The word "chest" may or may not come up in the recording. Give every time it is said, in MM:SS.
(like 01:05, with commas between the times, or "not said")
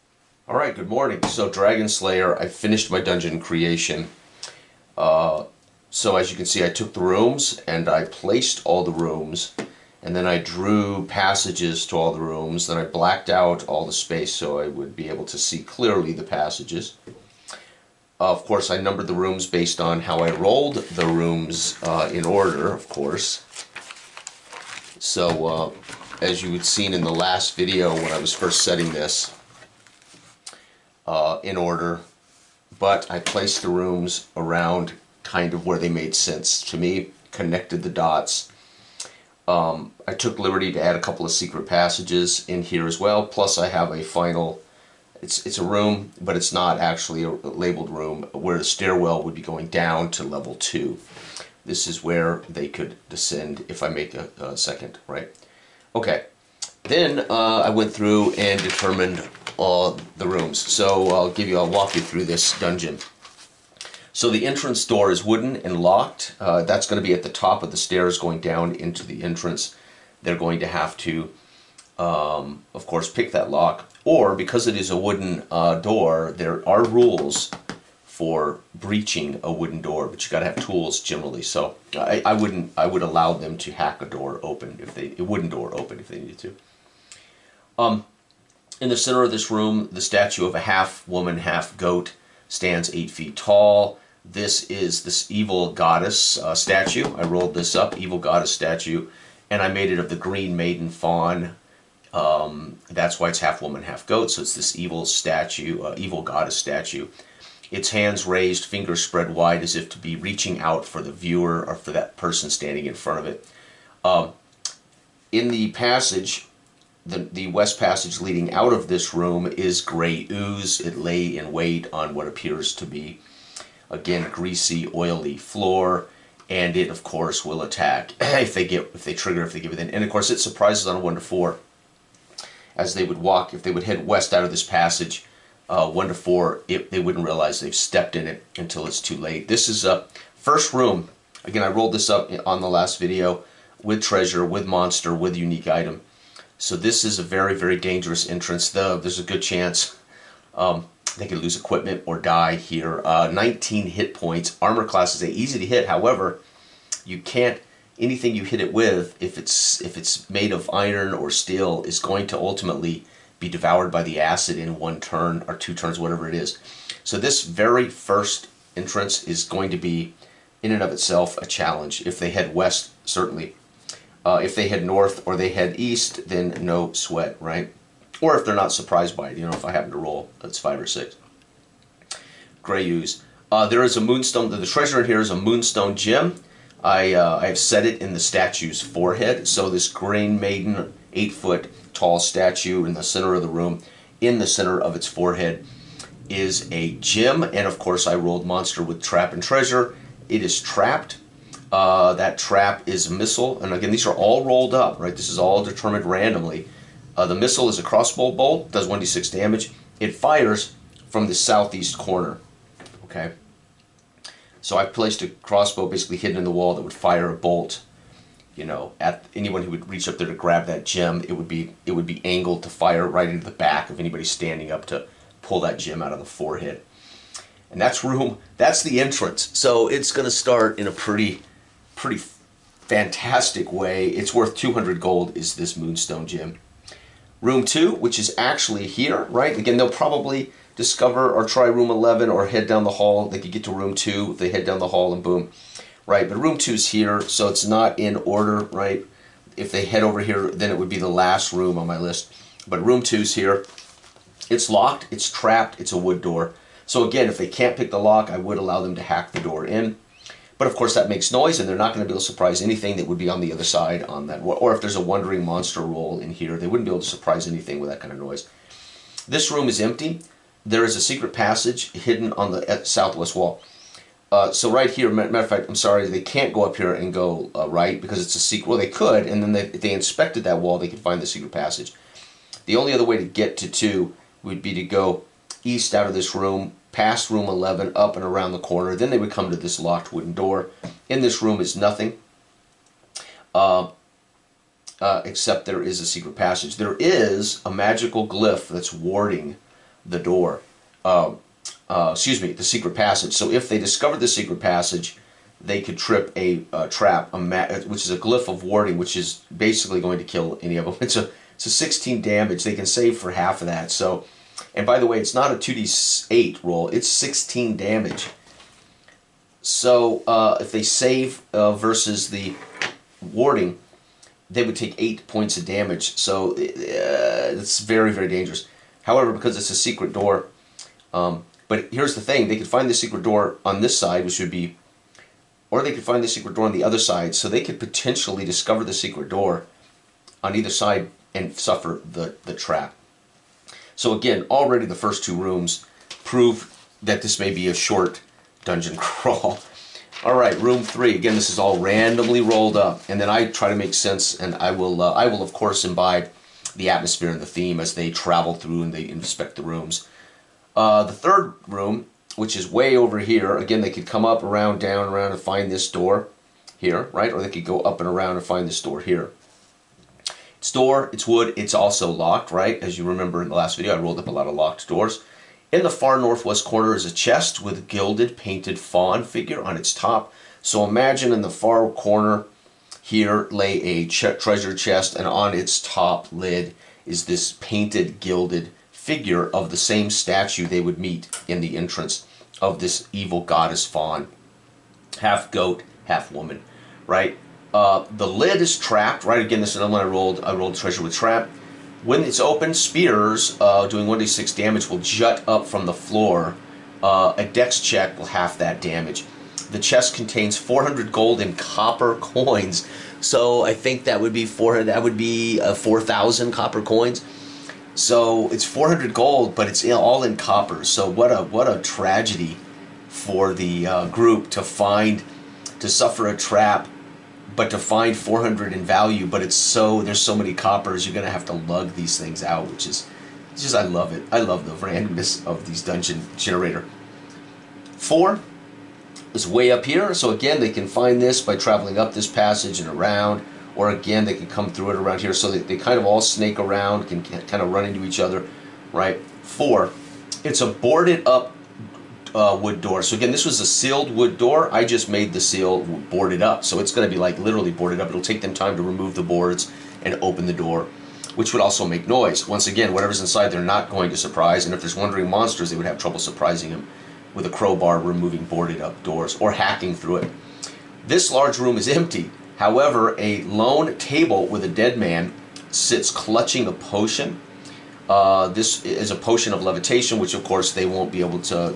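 06:17, 06:24, 06:49.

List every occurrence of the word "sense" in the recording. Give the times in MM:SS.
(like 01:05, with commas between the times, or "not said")
00:36, 05:53.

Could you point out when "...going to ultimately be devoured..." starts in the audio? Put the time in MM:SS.
02:41.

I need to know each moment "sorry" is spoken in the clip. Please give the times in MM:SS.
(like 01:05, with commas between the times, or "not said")
04:35.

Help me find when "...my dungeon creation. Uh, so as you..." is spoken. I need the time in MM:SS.
00:02.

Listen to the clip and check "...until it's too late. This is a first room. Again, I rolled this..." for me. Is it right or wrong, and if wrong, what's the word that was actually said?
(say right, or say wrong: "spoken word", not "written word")
right.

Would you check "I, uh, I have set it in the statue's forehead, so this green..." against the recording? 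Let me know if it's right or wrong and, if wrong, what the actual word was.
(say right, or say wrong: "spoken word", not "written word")
right.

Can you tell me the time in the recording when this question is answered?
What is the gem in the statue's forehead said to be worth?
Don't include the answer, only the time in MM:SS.
03:54.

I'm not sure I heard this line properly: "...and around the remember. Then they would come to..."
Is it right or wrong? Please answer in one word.
wrong.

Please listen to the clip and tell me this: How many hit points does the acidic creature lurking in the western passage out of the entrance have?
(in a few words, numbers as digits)
19.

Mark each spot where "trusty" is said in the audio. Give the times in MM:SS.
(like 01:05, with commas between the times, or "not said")
not said.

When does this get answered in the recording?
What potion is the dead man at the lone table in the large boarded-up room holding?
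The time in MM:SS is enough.
07:59.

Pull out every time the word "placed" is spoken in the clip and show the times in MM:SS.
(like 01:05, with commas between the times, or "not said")
00:08, 00:33, 03:34.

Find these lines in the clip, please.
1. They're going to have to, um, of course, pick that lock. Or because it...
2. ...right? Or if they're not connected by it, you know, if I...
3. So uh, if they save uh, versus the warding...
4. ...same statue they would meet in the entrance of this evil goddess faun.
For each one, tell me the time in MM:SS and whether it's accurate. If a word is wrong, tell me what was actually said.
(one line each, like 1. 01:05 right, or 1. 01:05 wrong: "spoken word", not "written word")
1. 01:10 right
2. 02:57 wrong: "surprised", not "connected"
3. 05:19 right
4. 06:29 right.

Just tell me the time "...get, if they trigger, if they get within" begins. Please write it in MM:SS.
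02:08.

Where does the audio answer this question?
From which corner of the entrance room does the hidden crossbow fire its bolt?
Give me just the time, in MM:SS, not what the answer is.
03:31.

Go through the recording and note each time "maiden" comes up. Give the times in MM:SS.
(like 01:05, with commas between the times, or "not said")
01:40, 03:10.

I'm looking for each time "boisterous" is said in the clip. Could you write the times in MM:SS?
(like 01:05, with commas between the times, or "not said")
not said.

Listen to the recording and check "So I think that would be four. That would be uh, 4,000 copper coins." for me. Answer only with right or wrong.
right.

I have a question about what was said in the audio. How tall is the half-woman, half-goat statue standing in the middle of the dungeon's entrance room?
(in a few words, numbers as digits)
8 feet.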